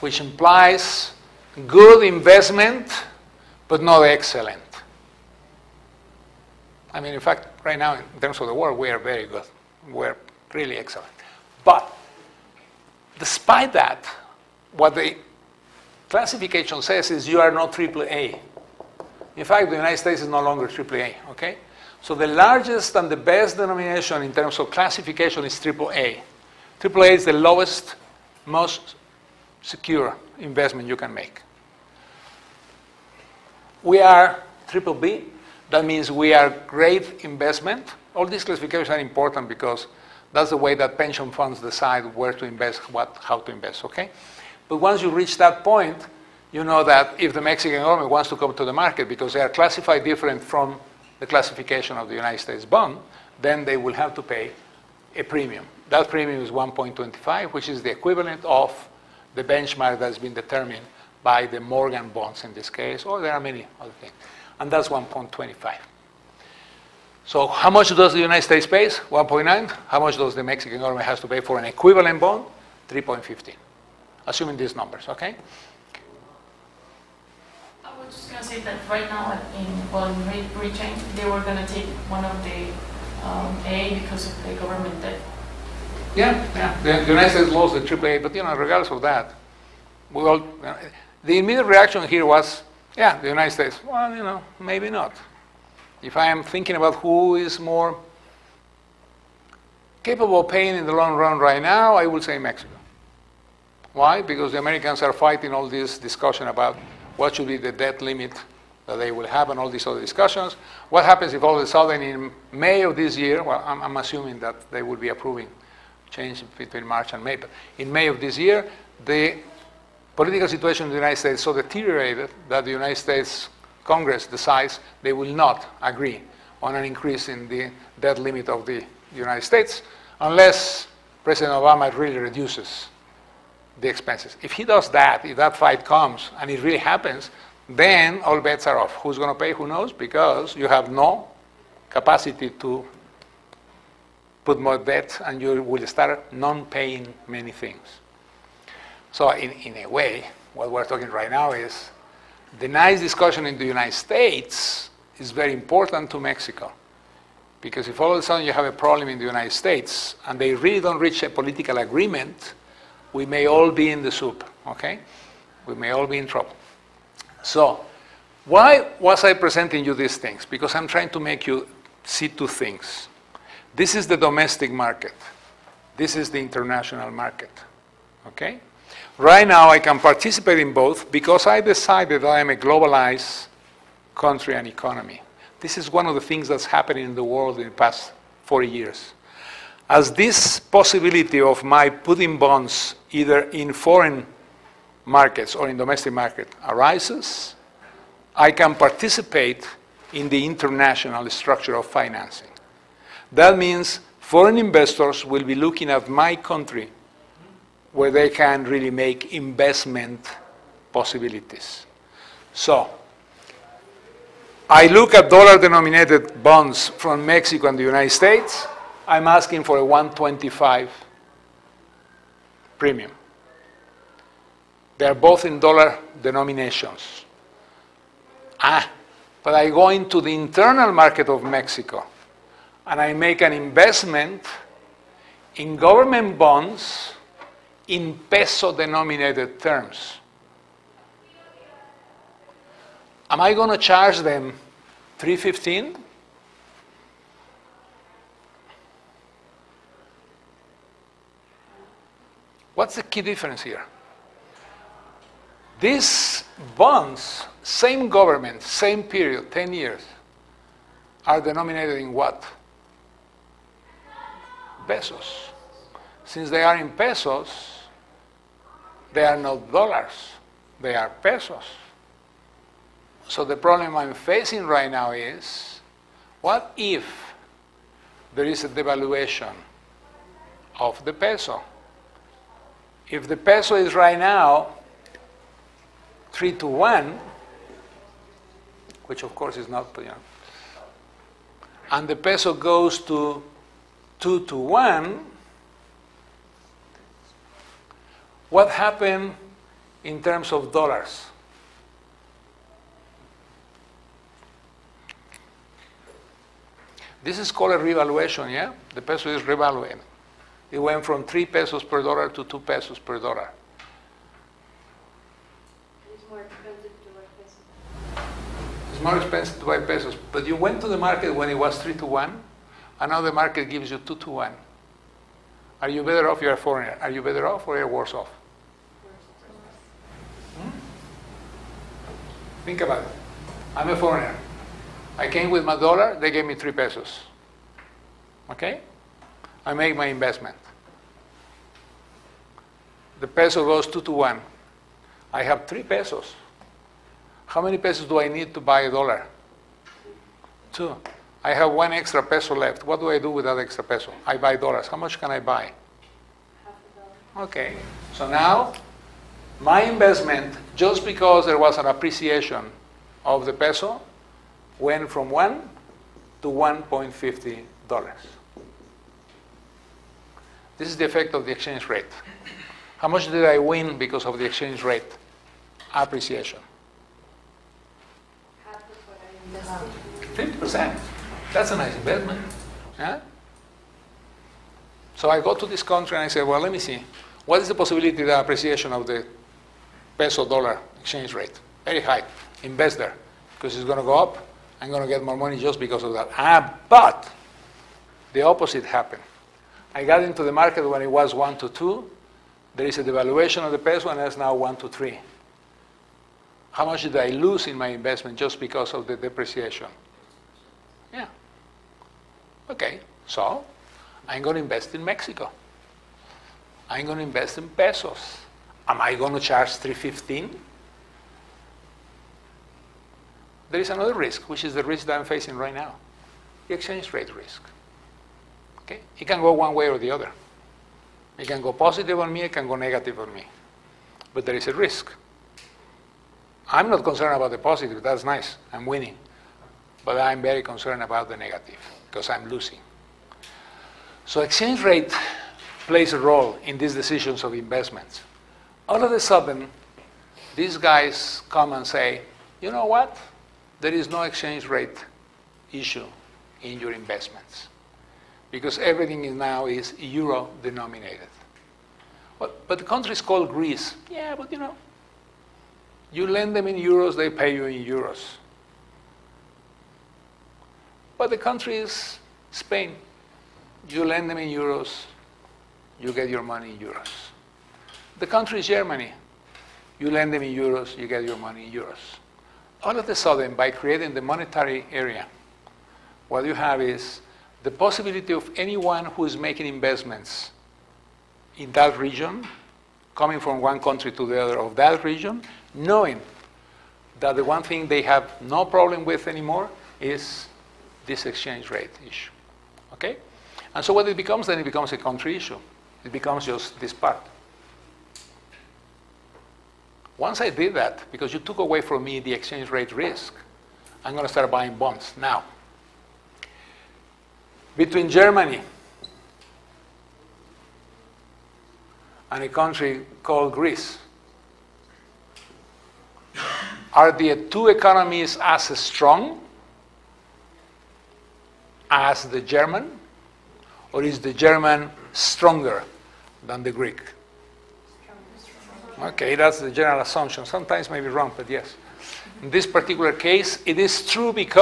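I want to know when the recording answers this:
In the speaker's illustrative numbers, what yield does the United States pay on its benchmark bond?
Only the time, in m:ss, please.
1:08.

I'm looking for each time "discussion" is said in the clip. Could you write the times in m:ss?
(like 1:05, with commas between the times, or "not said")
1:45, 1:50, 2:33.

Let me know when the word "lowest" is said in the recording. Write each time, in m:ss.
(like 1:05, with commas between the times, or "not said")
0:27.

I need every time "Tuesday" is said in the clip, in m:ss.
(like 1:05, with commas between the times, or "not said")
not said.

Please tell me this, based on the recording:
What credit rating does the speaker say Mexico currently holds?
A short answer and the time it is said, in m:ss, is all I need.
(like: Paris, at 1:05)
triple B, at 0:34.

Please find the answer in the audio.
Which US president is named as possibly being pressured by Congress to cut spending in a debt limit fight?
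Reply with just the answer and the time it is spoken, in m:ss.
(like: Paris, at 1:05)
Obama, at 2:11.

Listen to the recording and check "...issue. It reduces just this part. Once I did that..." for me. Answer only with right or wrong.
wrong.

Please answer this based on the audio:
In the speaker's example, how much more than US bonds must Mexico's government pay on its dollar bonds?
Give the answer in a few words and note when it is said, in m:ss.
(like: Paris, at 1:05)
1.25, at 0:55.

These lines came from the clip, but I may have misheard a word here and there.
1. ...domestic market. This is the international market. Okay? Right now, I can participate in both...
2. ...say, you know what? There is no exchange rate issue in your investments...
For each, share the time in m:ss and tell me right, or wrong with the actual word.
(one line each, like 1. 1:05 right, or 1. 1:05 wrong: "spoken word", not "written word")
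1. 2:54 right
2. 7:31 right.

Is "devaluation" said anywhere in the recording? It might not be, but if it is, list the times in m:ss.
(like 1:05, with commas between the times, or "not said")
4:38, 6:43.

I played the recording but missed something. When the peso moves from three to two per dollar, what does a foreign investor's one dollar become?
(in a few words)
$1.50.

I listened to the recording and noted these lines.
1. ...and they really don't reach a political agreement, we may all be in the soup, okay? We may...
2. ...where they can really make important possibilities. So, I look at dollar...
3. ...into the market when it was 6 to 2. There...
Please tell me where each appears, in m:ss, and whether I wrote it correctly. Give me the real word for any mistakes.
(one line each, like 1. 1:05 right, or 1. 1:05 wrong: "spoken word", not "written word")
1. 2:40 right
2. 3:27 wrong: "investment", not "important"
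3. 6:40 wrong: "1", not "6".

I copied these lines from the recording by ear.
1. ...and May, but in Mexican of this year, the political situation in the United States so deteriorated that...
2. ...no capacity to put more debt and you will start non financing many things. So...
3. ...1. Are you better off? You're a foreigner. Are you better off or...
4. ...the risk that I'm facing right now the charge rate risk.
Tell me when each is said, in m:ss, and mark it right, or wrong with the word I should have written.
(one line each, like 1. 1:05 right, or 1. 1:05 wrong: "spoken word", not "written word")
1. 1:57 wrong: "May", not "Mexican"
2. 2:20 wrong: "paying", not "financing"
3. 5:24 right
4. 7:04 wrong: "exchange", not "charge".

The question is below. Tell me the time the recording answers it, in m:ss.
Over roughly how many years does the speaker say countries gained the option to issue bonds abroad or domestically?
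3:08.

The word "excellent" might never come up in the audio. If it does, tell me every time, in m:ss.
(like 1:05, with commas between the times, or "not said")
0:04, 0:10.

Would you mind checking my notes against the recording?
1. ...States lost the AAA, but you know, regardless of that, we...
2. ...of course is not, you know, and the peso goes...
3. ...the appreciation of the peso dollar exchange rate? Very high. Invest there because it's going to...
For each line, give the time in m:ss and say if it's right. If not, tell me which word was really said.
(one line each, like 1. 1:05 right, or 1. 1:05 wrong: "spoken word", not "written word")
1. 1:27 right
2. 4:49 right
3. 6:28 right.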